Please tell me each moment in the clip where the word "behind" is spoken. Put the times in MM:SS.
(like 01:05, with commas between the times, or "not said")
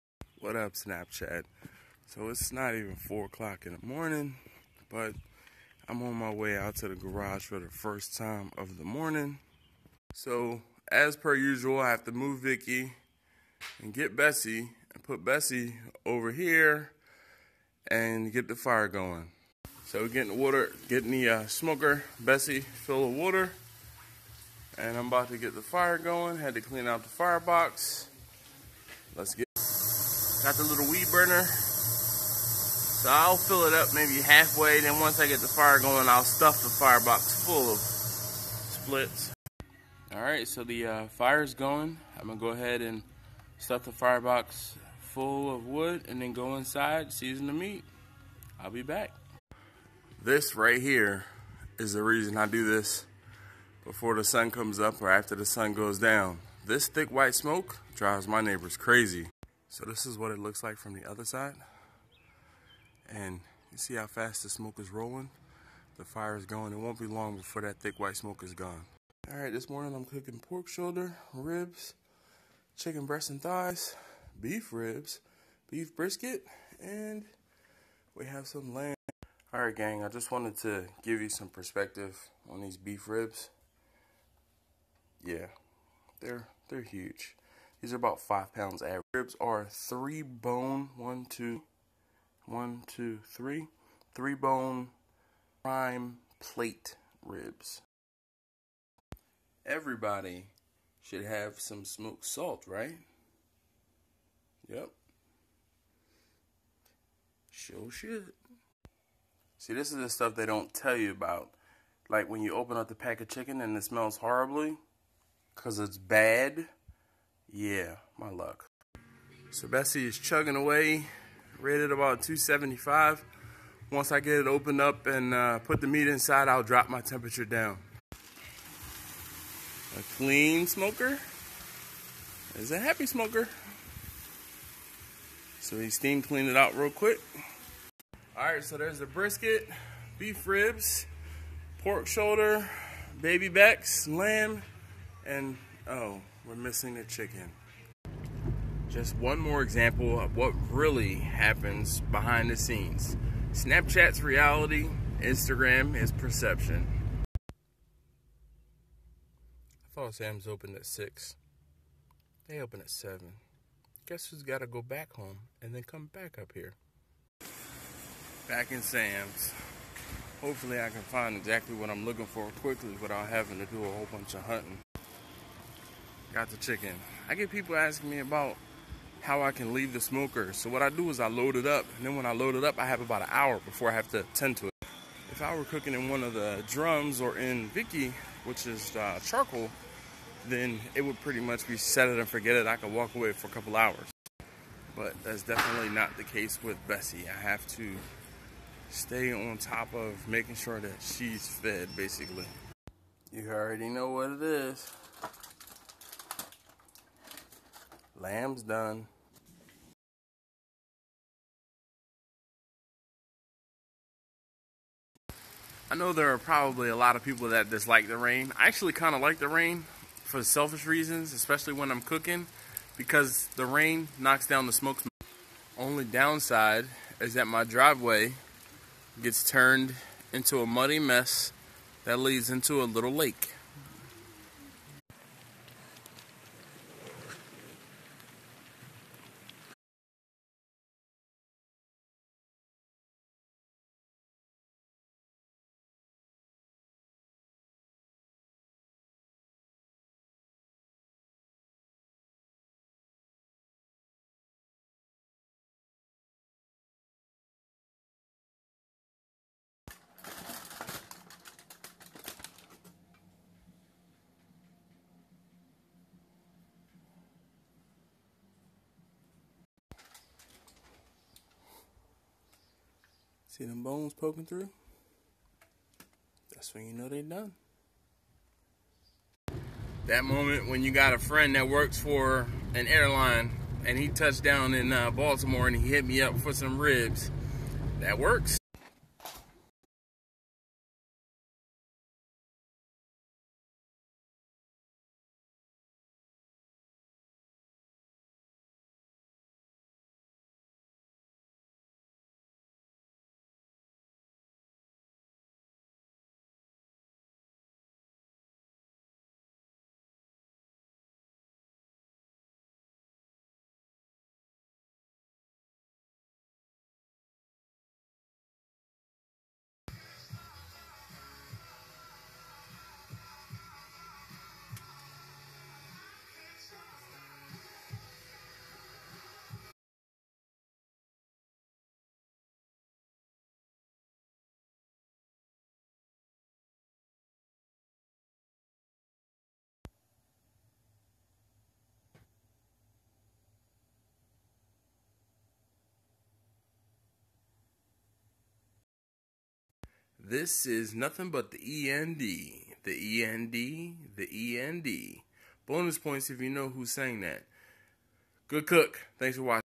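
02:32.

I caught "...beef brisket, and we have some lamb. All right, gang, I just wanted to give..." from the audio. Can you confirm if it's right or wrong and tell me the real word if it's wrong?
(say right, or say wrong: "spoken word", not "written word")
right.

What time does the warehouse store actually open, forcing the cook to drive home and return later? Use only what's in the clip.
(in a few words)
7.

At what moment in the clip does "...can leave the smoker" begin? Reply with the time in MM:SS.
02:59.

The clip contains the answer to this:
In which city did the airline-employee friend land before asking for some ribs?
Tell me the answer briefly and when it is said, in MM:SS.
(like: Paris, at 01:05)
Baltimore, at 04:45.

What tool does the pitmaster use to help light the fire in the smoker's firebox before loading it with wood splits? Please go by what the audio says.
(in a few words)
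weed burner.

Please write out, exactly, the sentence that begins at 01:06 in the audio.
It won't be long before that thick white smoke is gone.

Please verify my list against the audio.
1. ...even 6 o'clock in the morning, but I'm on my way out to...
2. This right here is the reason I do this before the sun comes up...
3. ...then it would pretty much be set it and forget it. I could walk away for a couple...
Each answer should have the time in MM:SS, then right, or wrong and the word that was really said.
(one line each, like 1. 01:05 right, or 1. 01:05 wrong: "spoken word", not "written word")
1. 00:02 wrong: "4", not "6"
2. 00:50 right
3. 03:10 right.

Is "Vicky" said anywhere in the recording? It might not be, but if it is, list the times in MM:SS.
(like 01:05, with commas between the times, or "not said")
00:12, 03:07.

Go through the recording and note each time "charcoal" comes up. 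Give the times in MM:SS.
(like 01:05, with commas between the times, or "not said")
03:09.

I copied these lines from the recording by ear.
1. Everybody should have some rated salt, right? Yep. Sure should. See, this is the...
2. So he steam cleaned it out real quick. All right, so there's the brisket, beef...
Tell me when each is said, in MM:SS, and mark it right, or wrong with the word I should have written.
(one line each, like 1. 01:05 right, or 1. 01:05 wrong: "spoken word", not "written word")
1. 01:39 wrong: "smoked", not "rated"
2. 02:15 right.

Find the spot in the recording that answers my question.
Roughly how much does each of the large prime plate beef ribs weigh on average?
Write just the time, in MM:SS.
01:28.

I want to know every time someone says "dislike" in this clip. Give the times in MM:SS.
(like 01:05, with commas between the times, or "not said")
03:37.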